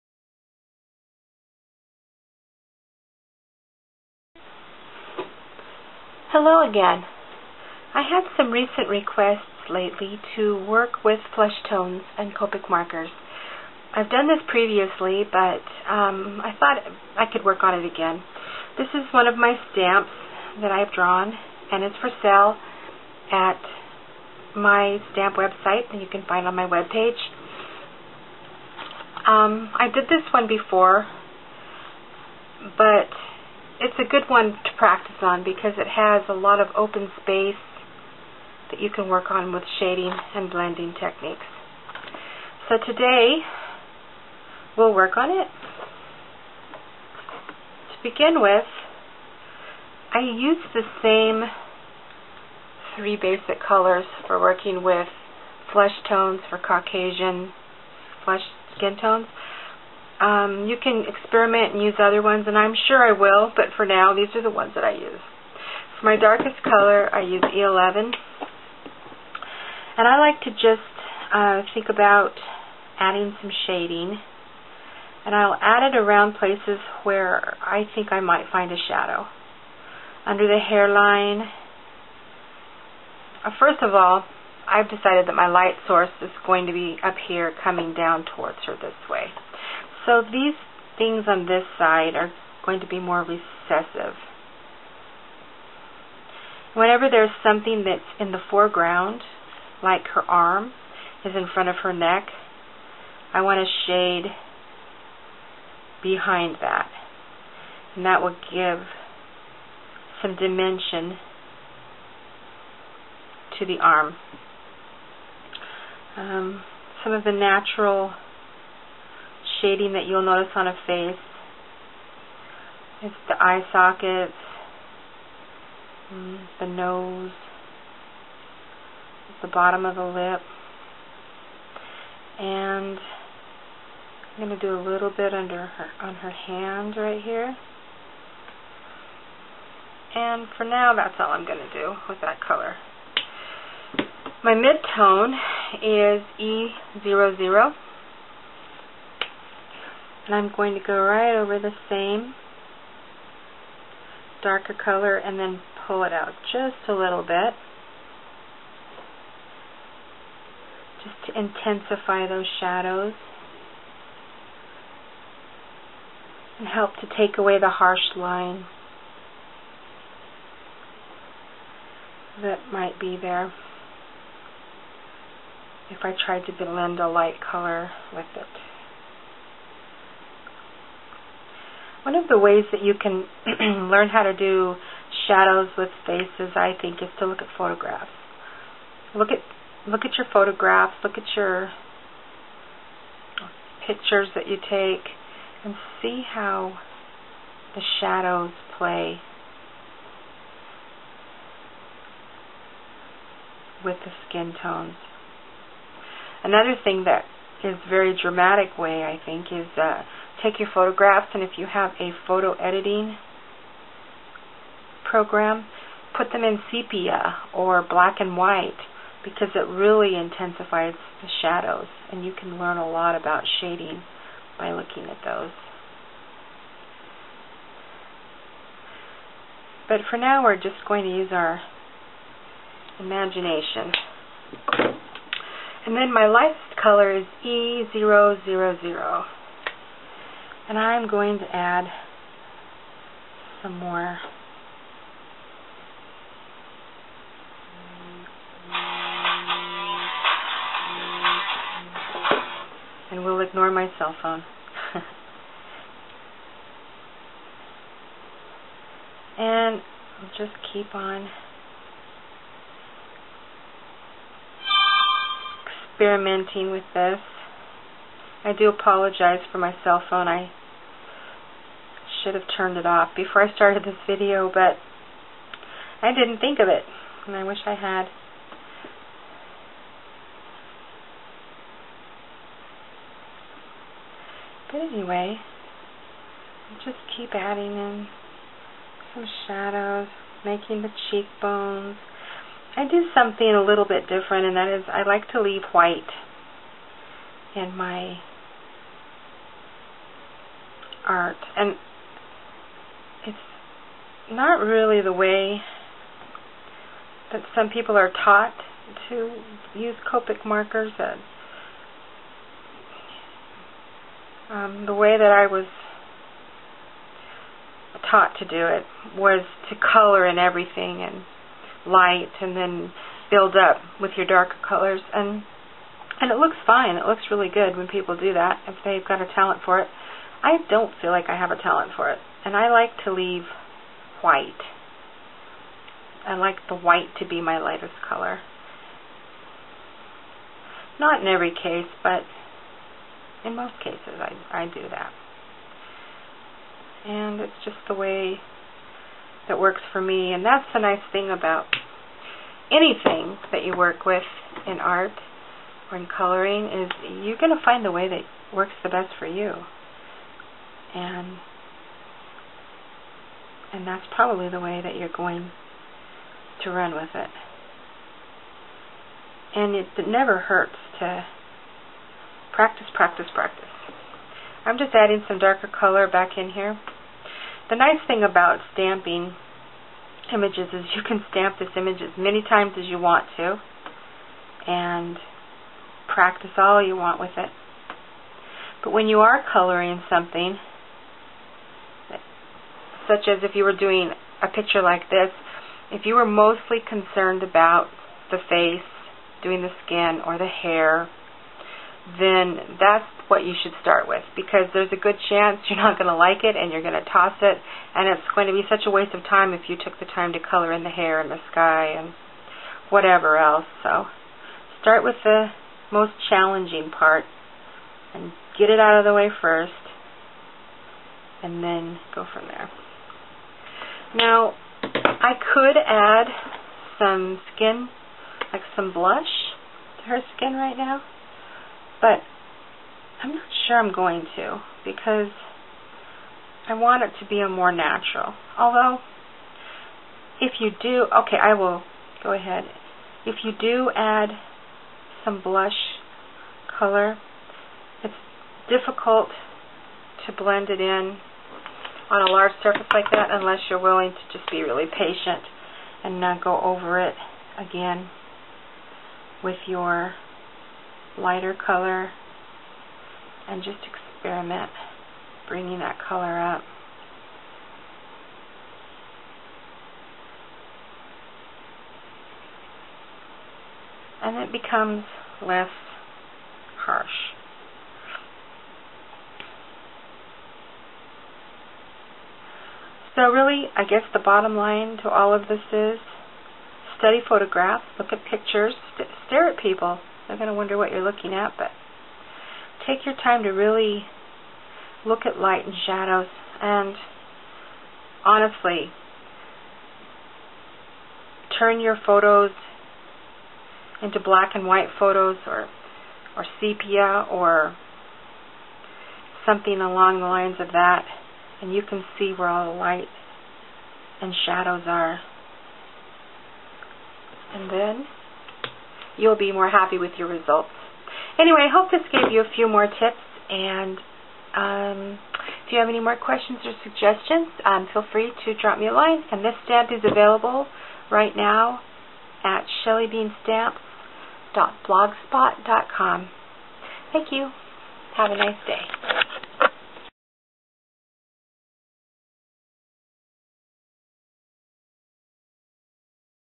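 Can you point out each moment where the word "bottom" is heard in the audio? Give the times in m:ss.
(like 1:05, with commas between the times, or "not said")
2:09, 8:04.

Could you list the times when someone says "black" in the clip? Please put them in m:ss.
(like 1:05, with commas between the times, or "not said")
3:37, 8:24.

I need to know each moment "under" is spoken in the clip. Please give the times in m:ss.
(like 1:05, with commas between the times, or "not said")
1:20, 2:15.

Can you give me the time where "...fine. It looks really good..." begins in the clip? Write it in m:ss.
5:26.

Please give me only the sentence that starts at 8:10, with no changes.
They're going to wonder what you're looking at, but take your time to really look at light and shadows.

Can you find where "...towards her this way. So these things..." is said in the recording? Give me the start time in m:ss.
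1:28.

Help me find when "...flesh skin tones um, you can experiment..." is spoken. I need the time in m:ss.
0:58.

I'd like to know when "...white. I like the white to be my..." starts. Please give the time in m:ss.
5:34.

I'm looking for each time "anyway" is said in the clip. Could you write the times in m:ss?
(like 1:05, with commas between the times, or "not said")
4:44, 8:41.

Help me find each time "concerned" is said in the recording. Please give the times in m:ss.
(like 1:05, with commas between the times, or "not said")
6:36.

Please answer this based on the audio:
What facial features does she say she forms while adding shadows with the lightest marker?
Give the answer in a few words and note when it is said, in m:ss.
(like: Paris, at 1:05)
Cheekbones, at 4:51.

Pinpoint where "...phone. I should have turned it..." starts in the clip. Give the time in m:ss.
4:30.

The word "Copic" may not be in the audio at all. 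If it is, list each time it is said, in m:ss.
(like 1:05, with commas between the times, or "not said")
0:12, 5:10.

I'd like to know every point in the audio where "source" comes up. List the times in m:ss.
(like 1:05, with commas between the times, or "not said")
1:25.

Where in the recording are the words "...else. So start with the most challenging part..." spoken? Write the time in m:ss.
6:53.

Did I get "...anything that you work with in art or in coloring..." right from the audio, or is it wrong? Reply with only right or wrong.
right.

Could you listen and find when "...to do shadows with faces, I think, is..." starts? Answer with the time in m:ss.
3:04.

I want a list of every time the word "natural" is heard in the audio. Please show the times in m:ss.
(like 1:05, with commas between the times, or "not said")
1:57, 7:17.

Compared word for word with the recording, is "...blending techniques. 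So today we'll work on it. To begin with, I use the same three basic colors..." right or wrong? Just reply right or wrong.
right.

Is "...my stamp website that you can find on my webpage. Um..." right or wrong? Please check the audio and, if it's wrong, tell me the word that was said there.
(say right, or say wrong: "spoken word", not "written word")
right.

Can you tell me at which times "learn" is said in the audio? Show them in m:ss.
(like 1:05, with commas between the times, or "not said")
3:03, 3:42.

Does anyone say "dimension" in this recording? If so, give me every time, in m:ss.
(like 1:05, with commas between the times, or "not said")
1:50.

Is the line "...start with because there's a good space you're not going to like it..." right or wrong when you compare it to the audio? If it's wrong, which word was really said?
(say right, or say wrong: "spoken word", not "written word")
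wrong: "chance", not "space".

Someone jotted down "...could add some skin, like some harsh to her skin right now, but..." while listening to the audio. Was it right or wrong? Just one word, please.
wrong.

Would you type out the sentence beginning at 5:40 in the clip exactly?
Not in every case, but in most cases I, I do that.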